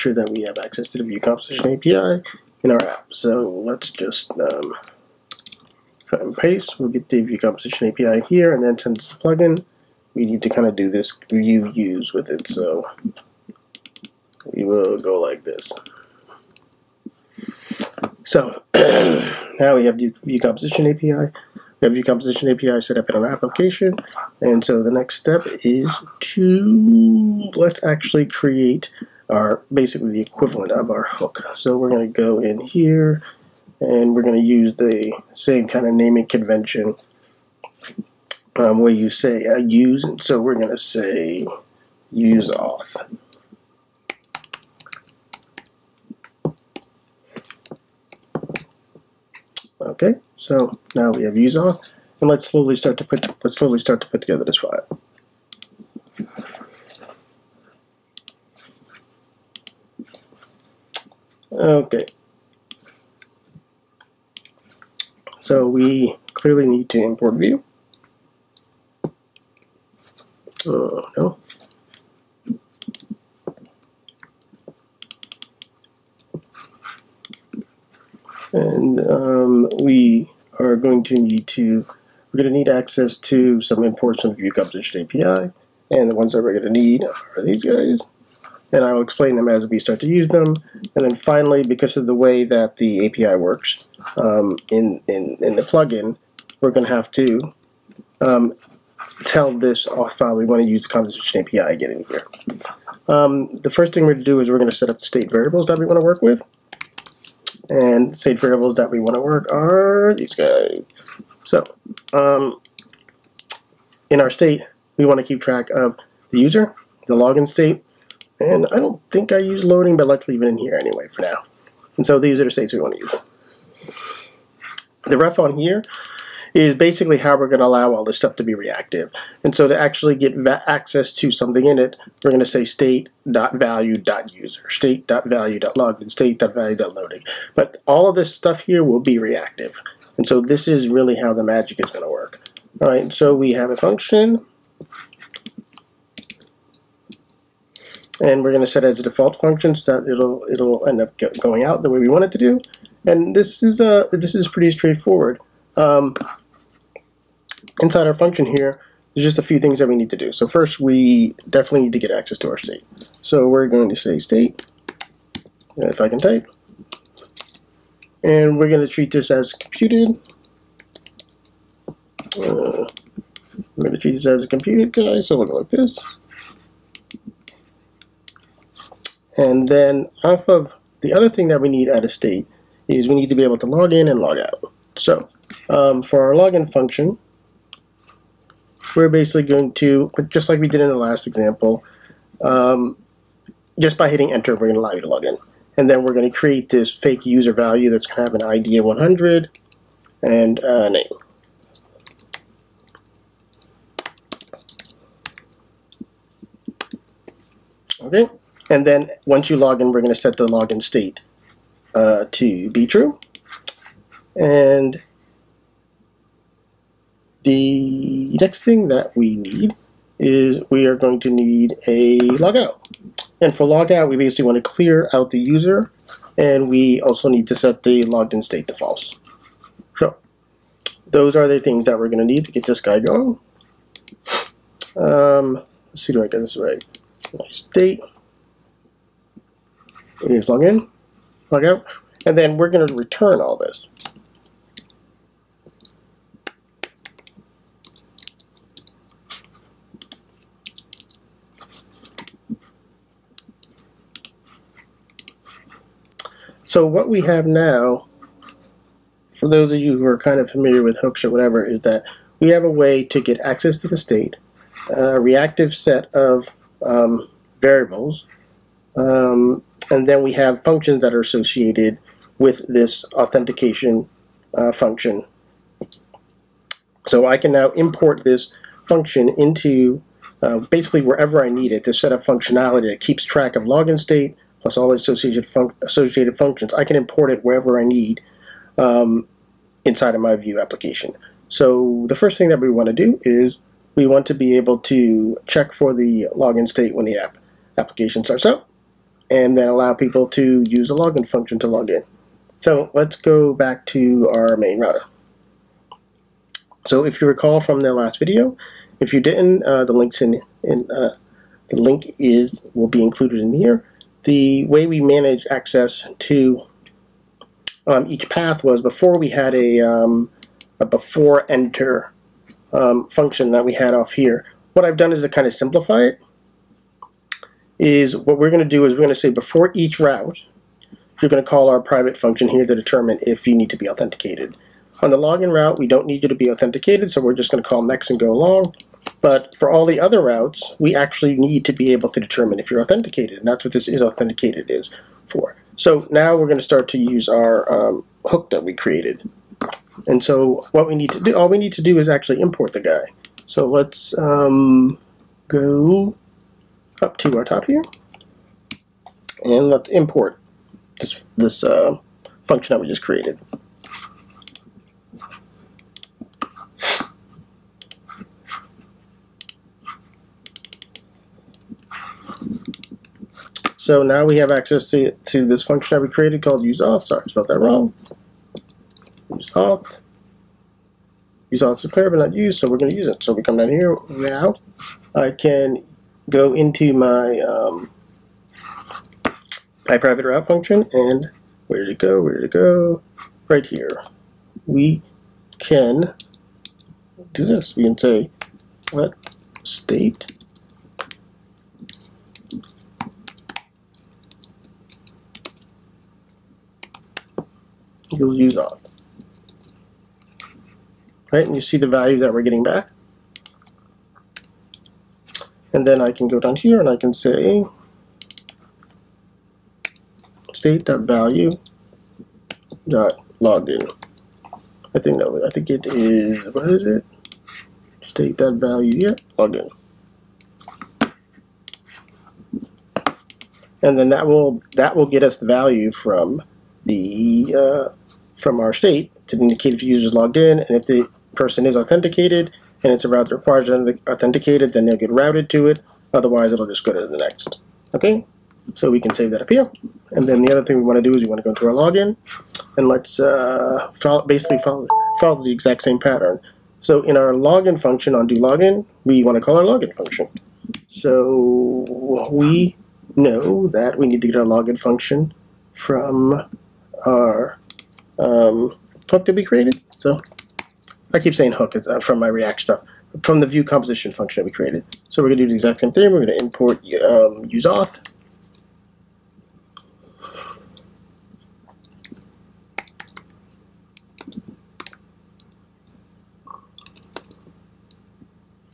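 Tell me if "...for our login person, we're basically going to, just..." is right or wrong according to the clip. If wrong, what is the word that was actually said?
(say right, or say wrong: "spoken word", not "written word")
wrong: "function", not "person".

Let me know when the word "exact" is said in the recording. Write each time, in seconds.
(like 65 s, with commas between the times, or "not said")
455 s, 475 s.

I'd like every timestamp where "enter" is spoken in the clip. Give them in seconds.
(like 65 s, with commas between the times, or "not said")
194 s, 321 s.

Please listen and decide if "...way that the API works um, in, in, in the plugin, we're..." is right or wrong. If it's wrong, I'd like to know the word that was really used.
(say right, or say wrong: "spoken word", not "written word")
right.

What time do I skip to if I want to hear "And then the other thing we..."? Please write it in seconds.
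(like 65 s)
450 s.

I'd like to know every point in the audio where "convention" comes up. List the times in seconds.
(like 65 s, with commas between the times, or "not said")
36 s.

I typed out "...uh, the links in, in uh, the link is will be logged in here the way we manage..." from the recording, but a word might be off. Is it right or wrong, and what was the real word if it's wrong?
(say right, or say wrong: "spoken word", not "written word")
wrong: "included", not "logged".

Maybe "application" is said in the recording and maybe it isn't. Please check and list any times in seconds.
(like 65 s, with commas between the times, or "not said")
23 s, 290 s, 297 s.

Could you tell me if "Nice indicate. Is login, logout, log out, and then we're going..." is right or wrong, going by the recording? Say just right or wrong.
wrong.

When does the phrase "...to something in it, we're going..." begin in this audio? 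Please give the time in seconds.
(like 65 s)
131 s.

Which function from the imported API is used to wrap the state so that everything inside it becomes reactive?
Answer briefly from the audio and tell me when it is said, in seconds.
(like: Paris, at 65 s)
ref, at 125 s.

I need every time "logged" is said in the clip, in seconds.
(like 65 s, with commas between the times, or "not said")
228 s, 423 s, 429 s, 440 s.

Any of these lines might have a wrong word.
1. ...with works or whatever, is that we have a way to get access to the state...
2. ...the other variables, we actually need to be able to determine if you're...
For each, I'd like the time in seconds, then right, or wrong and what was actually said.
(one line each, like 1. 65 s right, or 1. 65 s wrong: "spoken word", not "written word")
1. 260 s wrong: "hooks", not "works"
2. 339 s wrong: "routes", not "variables".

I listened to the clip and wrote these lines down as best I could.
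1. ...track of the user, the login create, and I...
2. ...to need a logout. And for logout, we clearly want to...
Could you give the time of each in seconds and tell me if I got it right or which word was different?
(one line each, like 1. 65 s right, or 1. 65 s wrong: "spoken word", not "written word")
1. 115 s wrong: "state", not "create"
2. 221 s wrong: "basically", not "clearly".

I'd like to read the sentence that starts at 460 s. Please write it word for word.
So we know that we need to get our login function from our um, hook that we created.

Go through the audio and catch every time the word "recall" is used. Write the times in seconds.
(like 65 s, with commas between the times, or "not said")
307 s.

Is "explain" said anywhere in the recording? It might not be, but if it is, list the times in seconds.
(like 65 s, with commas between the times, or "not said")
89 s.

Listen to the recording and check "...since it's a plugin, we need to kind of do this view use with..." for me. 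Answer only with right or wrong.
right.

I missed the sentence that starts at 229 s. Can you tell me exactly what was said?
So those are the things that we're going to need to get this guy going.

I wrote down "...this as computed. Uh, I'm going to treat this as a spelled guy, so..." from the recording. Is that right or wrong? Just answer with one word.
wrong.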